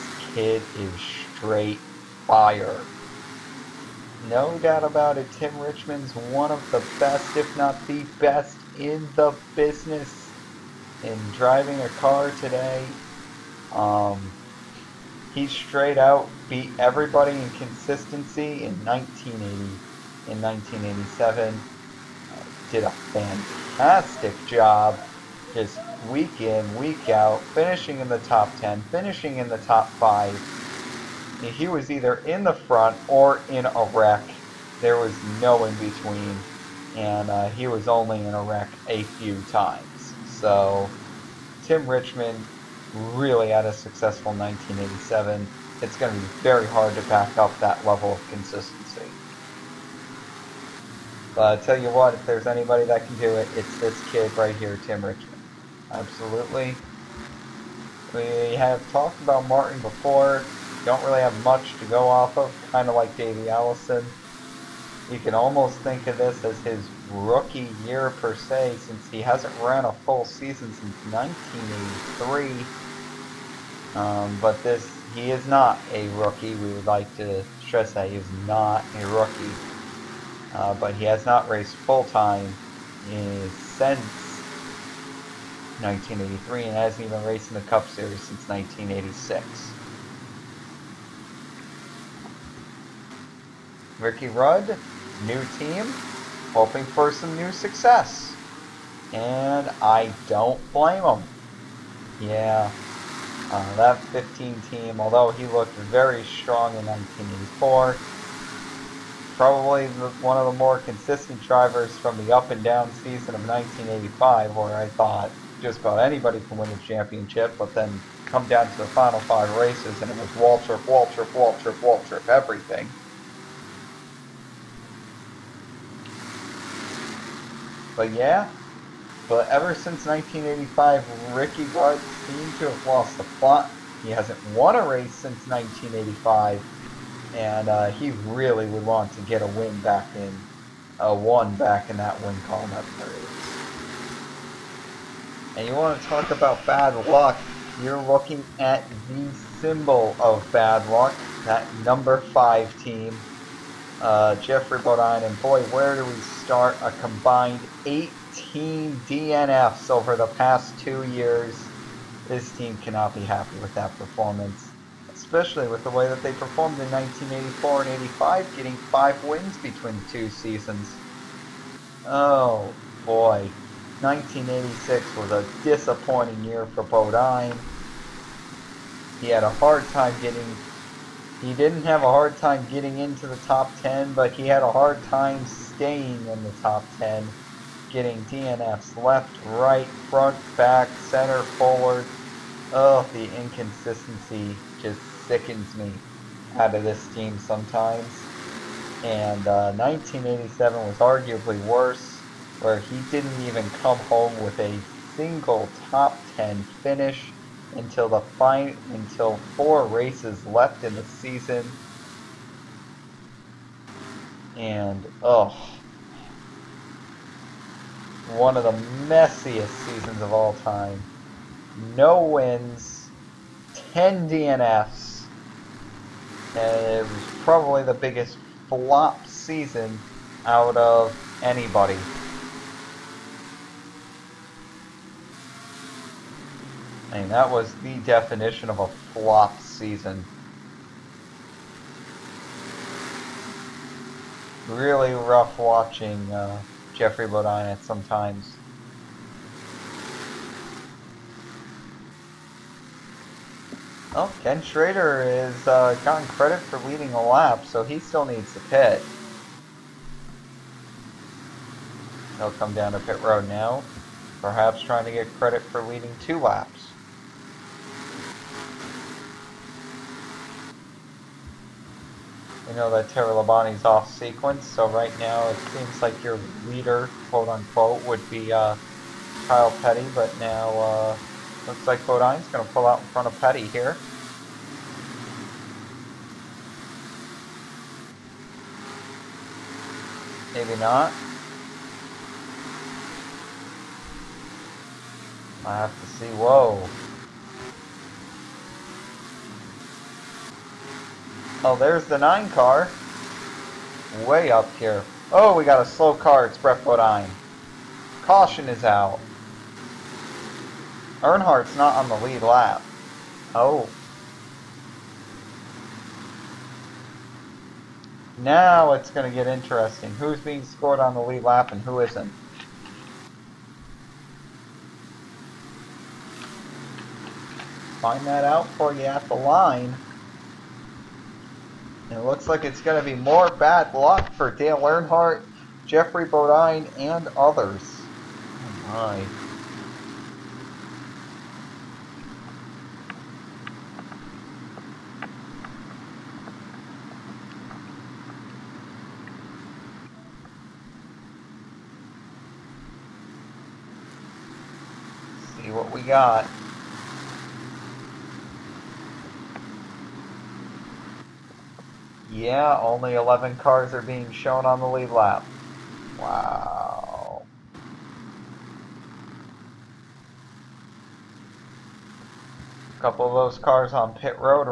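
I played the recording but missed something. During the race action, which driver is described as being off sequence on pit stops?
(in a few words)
Terry Labonte.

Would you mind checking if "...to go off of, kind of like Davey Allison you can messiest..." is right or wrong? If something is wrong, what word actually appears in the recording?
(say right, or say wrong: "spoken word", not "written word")
wrong: "almost", not "messiest".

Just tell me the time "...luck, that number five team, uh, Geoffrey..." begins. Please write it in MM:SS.
02:30.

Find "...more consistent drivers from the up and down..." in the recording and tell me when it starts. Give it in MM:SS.
01:50.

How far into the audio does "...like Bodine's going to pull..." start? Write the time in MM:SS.
04:41.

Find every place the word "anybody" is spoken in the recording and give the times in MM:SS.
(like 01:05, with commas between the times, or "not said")
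00:52, 01:55, 03:51.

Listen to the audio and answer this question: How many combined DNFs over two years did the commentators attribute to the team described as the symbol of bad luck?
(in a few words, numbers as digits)
18.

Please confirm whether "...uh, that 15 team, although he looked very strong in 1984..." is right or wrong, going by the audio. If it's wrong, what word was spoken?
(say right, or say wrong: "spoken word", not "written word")
right.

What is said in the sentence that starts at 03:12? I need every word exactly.
Oh, the inconsistency just sickens me out of this team sometimes.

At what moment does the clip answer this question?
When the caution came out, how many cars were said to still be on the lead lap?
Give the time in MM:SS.
06:03.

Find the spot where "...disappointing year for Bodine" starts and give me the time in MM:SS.
02:55.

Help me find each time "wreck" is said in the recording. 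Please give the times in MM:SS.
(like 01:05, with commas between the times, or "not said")
00:33, 00:38.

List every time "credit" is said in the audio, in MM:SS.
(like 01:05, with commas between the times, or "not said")
04:16, 04:25.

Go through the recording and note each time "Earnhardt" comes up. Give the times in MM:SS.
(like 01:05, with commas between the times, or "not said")
05:11, 05:34.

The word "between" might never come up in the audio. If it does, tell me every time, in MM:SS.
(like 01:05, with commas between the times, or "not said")
00:35, 02:49.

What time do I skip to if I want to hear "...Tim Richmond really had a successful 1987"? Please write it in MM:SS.
00:41.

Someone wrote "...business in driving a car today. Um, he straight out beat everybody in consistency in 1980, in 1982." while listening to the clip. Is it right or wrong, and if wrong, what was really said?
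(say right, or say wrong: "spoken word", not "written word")
wrong: "1987", not "1982".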